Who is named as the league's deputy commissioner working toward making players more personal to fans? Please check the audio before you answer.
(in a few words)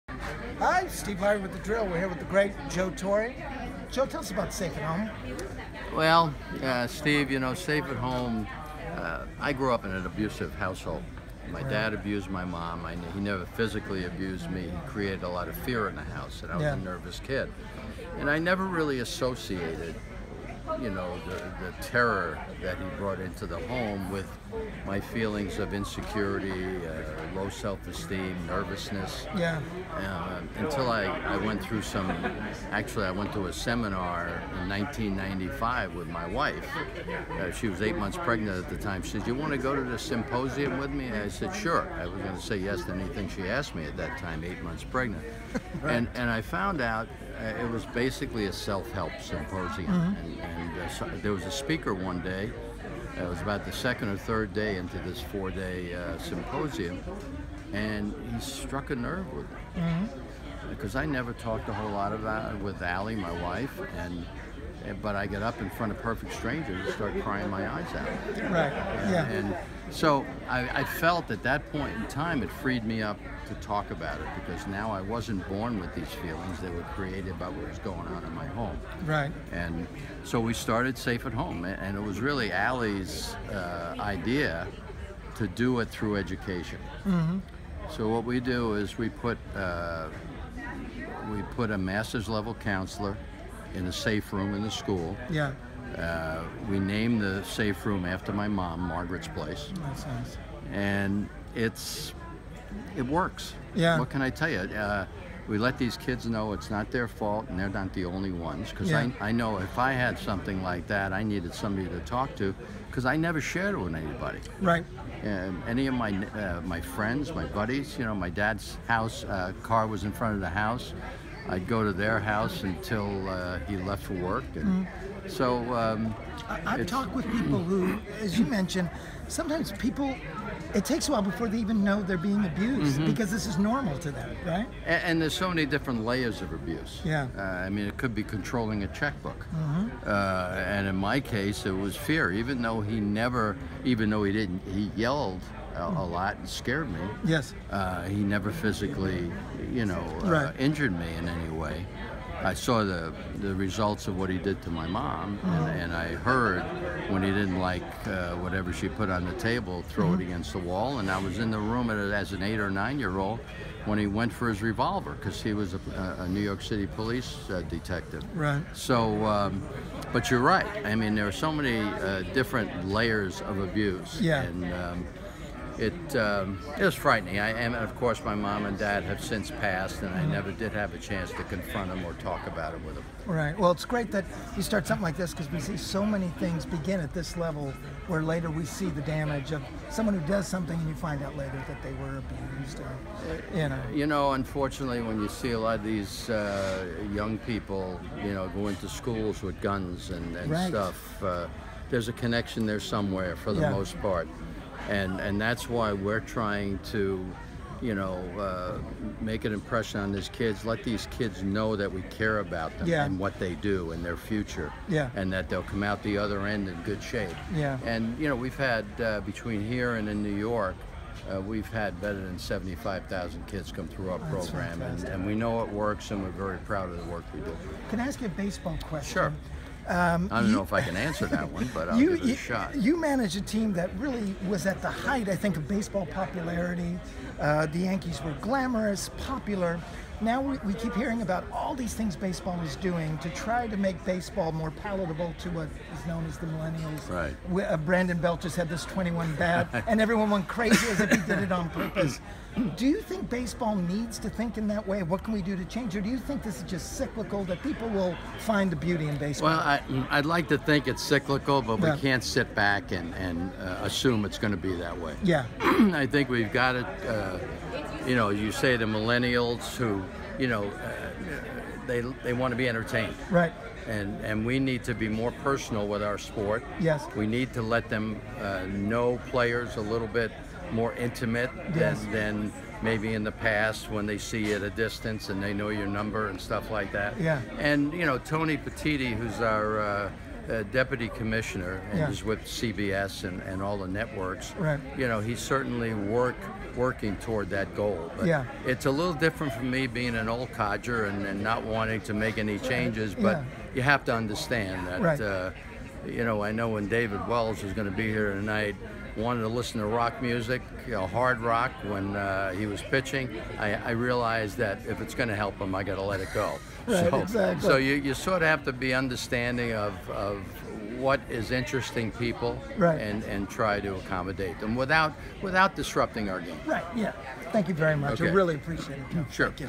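Tony Petitti.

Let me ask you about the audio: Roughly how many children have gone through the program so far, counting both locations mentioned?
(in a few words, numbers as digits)
75,000.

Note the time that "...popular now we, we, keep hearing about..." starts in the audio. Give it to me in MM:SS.
03:59.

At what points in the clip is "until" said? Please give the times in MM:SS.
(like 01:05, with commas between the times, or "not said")
00:30, 02:02.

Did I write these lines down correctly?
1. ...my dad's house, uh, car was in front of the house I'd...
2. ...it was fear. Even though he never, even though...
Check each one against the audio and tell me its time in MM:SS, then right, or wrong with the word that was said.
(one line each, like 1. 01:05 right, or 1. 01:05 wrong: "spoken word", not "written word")
1. 01:58 right
2. 02:21 right.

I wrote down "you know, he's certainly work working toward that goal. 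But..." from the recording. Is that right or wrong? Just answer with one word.
right.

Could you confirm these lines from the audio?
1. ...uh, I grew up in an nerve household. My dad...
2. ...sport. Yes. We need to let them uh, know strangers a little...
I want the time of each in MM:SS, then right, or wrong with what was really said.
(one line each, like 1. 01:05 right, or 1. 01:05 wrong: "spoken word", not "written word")
1. 00:08 wrong: "abusive", not "nerve"
2. 04:36 wrong: "players", not "strangers".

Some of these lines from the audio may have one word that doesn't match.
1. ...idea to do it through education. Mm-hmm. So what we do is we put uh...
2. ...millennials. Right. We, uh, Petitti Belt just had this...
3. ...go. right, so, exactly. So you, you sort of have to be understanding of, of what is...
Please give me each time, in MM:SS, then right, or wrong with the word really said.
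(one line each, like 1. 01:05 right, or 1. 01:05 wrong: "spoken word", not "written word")
1. 01:23 right
2. 04:06 wrong: "Brandon", not "Petitti"
3. 05:16 right.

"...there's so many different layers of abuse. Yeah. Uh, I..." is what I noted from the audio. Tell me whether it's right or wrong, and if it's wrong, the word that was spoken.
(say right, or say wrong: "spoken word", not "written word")
right.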